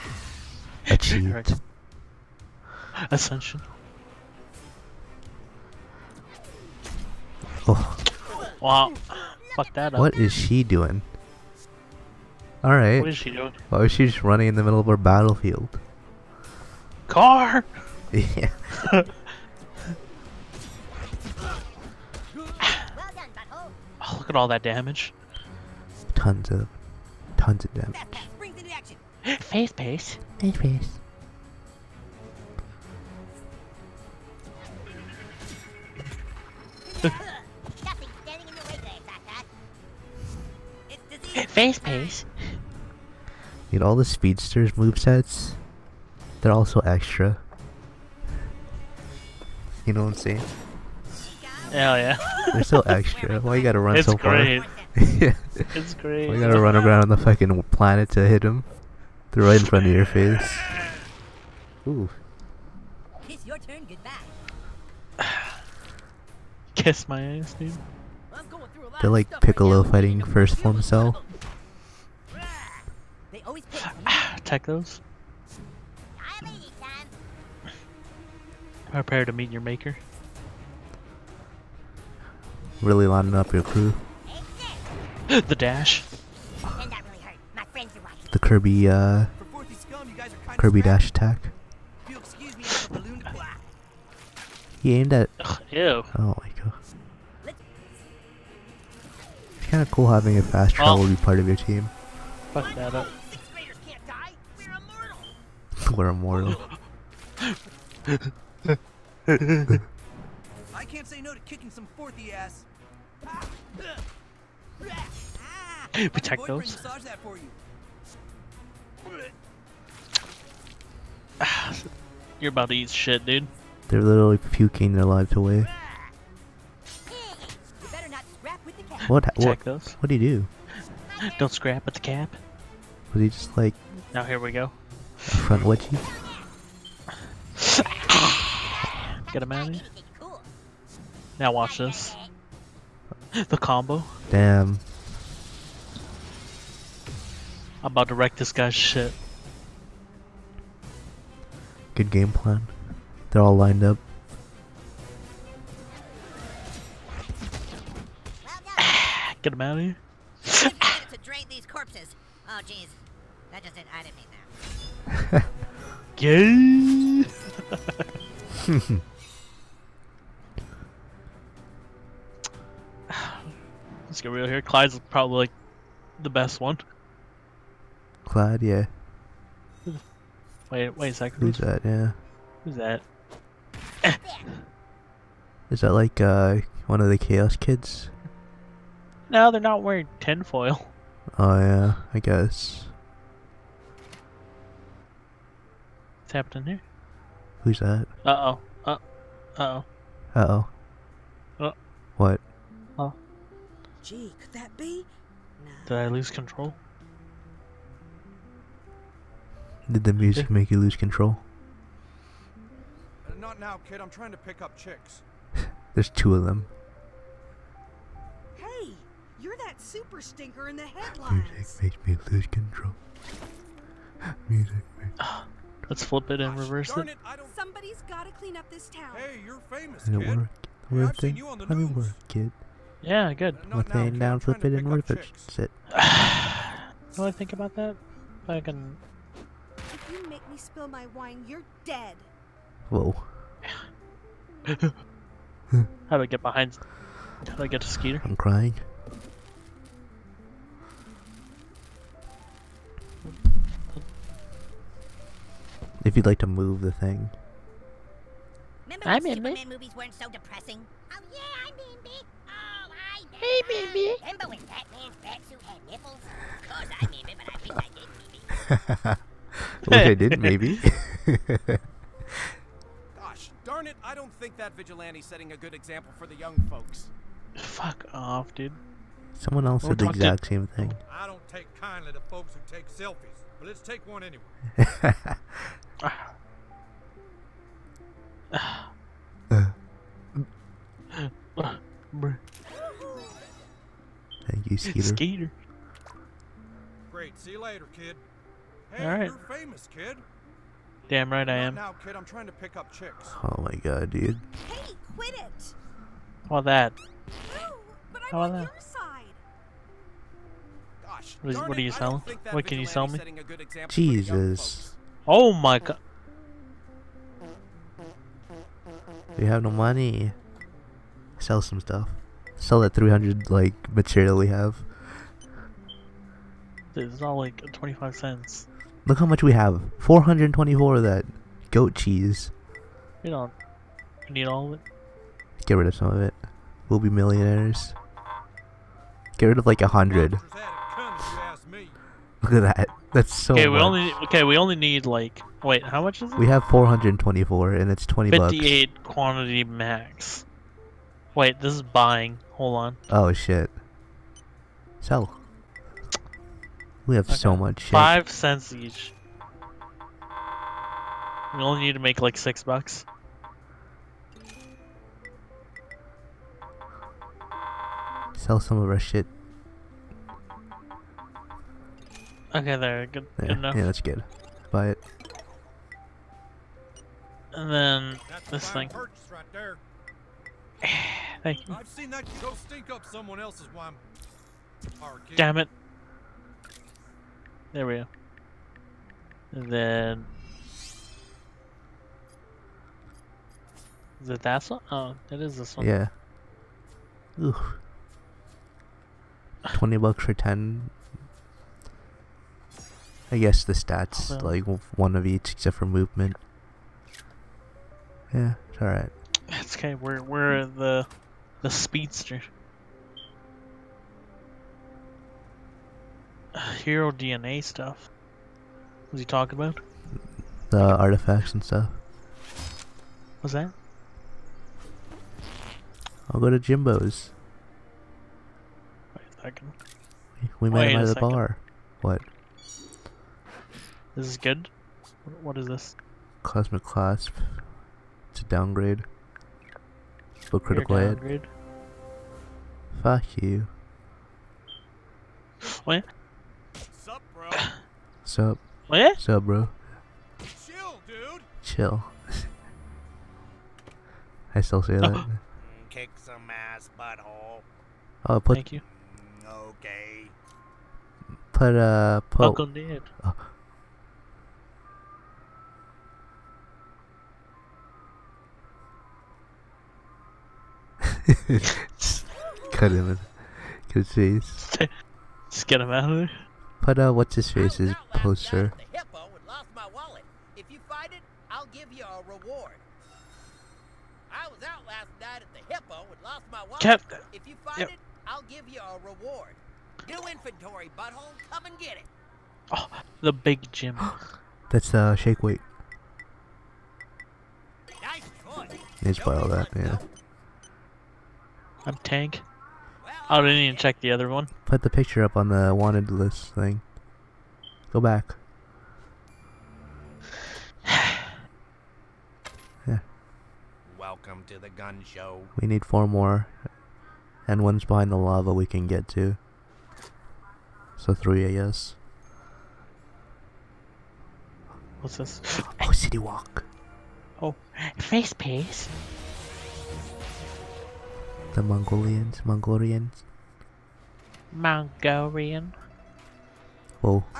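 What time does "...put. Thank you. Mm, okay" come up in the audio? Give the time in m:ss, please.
7:38.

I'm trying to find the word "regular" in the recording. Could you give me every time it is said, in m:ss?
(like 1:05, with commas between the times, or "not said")
not said.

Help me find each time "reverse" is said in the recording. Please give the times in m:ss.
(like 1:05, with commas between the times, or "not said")
3:46, 3:54.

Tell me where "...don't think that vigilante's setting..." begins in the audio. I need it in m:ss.
4:34.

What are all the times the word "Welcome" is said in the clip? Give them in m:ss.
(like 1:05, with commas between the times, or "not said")
8:33.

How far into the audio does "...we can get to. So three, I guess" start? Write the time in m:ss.
8:38.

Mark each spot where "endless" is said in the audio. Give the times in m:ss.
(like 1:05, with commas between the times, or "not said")
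not said.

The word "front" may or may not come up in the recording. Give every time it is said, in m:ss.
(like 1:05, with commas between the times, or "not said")
0:59, 2:15.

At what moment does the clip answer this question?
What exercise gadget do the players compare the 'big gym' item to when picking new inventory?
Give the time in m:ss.
8:15.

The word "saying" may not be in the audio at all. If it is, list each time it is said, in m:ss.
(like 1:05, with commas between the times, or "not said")
0:50.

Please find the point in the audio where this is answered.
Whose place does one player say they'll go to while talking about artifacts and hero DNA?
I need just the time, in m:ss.
7:06.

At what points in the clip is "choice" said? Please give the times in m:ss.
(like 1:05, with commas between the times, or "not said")
8:18.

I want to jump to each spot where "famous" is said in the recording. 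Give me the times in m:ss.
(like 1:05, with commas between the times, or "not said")
3:49, 4:59.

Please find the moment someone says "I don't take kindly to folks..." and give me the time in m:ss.
4:41.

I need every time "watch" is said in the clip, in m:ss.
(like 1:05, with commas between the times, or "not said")
2:21.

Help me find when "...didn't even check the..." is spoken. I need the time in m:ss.
8:23.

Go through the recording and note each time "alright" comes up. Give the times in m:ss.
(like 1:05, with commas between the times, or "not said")
0:12, 6:48.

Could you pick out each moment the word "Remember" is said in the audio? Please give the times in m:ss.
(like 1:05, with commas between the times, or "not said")
4:18, 4:24.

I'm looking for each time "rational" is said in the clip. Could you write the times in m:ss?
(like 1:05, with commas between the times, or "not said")
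not said.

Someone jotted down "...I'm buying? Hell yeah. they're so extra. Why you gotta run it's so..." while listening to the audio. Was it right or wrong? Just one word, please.
wrong.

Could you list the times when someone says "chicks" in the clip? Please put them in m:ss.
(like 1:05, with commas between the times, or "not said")
3:34, 5:02.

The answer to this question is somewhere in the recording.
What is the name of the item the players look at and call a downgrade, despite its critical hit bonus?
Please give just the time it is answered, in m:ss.
7:16.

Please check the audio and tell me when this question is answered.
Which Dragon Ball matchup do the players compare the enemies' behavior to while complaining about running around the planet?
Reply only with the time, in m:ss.
1:09.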